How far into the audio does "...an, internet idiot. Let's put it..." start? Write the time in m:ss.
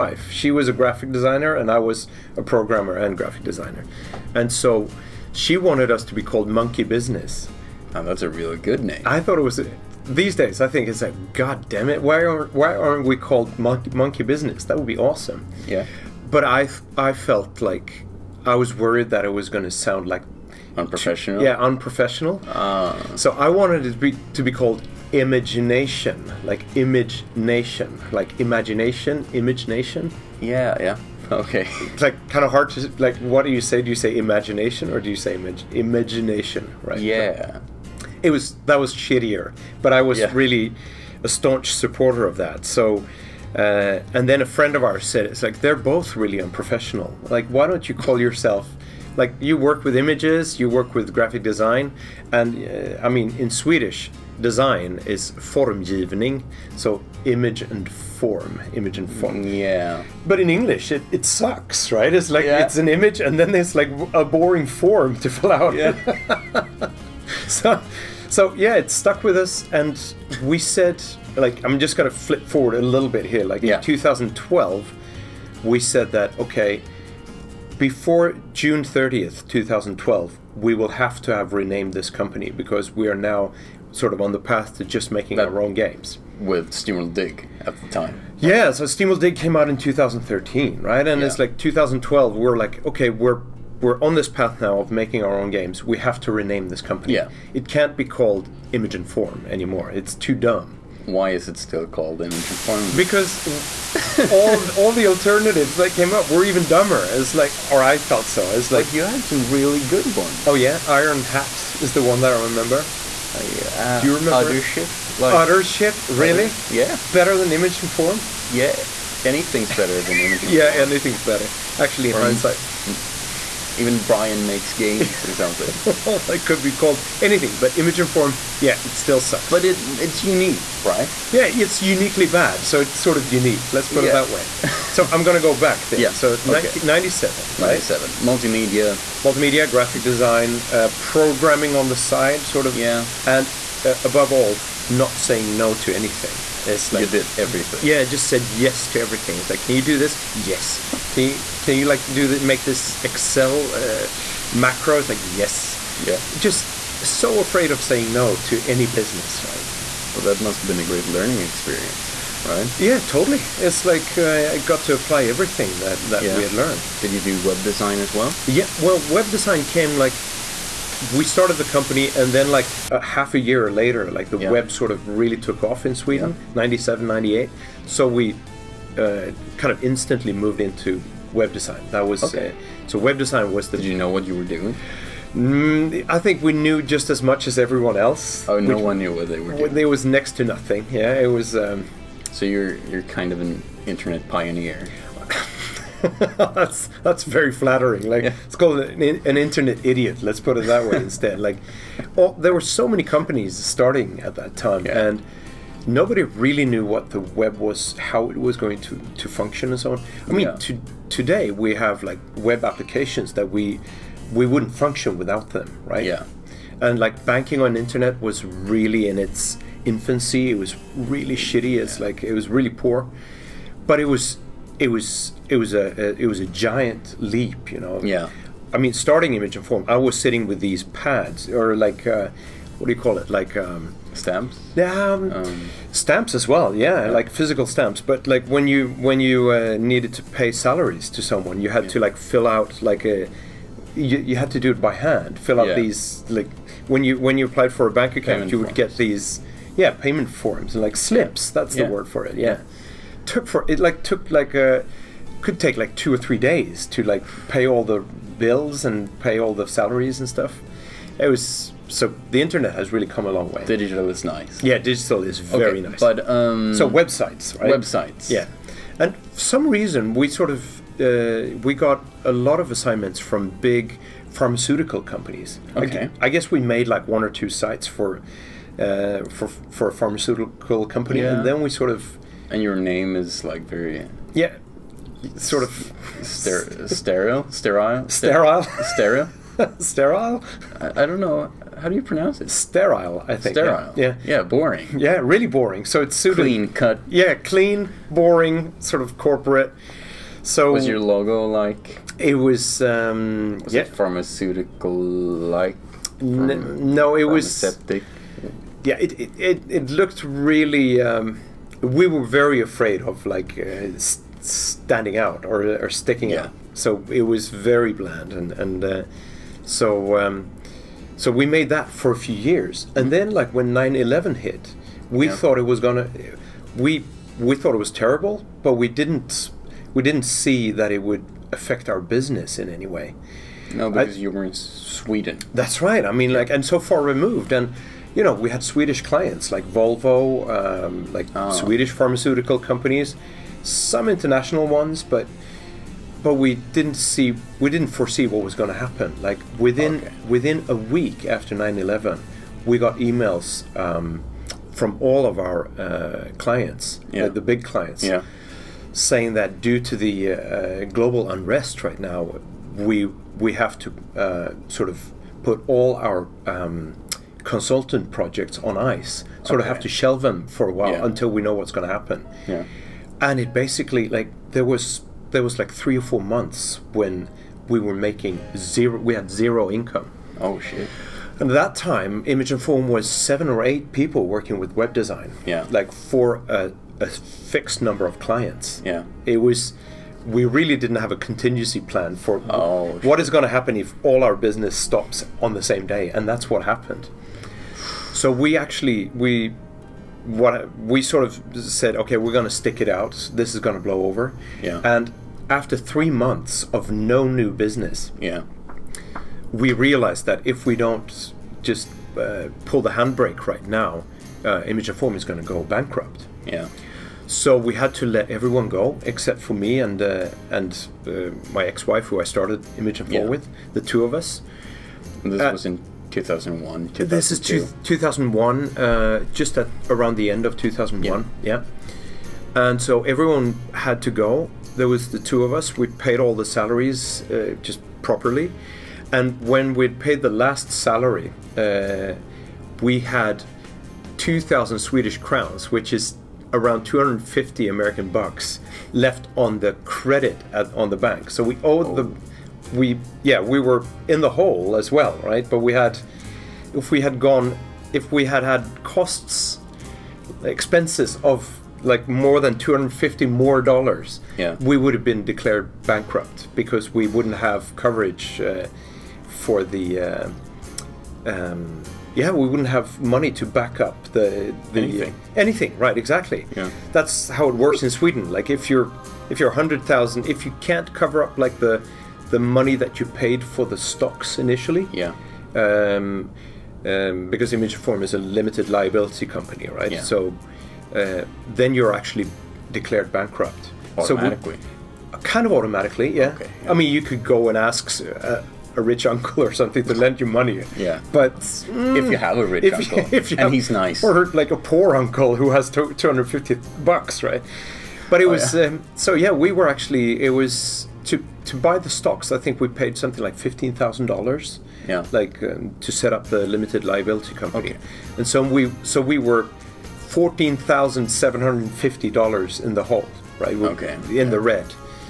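3:19.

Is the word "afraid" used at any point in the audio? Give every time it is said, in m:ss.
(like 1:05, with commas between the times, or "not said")
2:37, 5:12.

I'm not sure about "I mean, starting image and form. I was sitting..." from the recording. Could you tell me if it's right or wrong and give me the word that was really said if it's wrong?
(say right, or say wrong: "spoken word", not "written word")
right.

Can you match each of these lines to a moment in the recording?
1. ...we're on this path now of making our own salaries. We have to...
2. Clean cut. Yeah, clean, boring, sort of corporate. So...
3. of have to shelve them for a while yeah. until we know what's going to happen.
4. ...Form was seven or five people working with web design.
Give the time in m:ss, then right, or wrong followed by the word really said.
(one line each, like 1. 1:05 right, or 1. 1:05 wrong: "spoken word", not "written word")
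1. 1:33 wrong: "games", not "salaries"
2. 4:56 right
3. 6:09 right
4. 6:22 wrong: "eight", not "five".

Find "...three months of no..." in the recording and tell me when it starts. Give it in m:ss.
6:45.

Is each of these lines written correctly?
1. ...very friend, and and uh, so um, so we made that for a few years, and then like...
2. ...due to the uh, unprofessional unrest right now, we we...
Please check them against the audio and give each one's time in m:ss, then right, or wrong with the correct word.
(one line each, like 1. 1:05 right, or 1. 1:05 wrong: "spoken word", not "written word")
1. 5:17 wrong: "bland", not "friend"
2. 5:59 wrong: "global", not "unprofessional".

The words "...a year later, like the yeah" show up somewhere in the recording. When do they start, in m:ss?
2:53.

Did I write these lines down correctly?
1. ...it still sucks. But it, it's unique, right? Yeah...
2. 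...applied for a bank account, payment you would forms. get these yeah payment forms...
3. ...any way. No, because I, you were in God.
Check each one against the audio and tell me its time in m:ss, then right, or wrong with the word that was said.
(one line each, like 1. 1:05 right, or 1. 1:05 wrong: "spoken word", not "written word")
1. 2:08 right
2. 4:07 right
3. 5:32 wrong: "Sweden", not "God".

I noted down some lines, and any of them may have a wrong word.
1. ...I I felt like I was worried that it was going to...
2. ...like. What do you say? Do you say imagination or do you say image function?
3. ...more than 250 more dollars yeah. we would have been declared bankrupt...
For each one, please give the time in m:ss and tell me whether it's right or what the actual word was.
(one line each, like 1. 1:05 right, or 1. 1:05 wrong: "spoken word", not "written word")
1. 0:16 right
2. 0:32 wrong: "imagination", not "function"
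3. 7:42 right.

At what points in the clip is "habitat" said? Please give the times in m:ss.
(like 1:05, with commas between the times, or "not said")
not said.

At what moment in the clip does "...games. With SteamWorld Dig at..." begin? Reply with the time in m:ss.
1:25.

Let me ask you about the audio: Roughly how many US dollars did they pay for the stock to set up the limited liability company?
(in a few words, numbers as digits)
15,000.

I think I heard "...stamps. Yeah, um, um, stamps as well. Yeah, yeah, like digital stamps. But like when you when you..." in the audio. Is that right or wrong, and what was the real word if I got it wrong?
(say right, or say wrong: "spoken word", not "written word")
wrong: "physical", not "digital".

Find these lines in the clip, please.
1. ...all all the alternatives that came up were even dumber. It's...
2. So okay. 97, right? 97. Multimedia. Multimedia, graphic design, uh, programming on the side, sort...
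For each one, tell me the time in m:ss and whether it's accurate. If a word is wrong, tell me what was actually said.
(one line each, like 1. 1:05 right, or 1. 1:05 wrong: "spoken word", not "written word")
1. 1:44 right
2. 2:16 right.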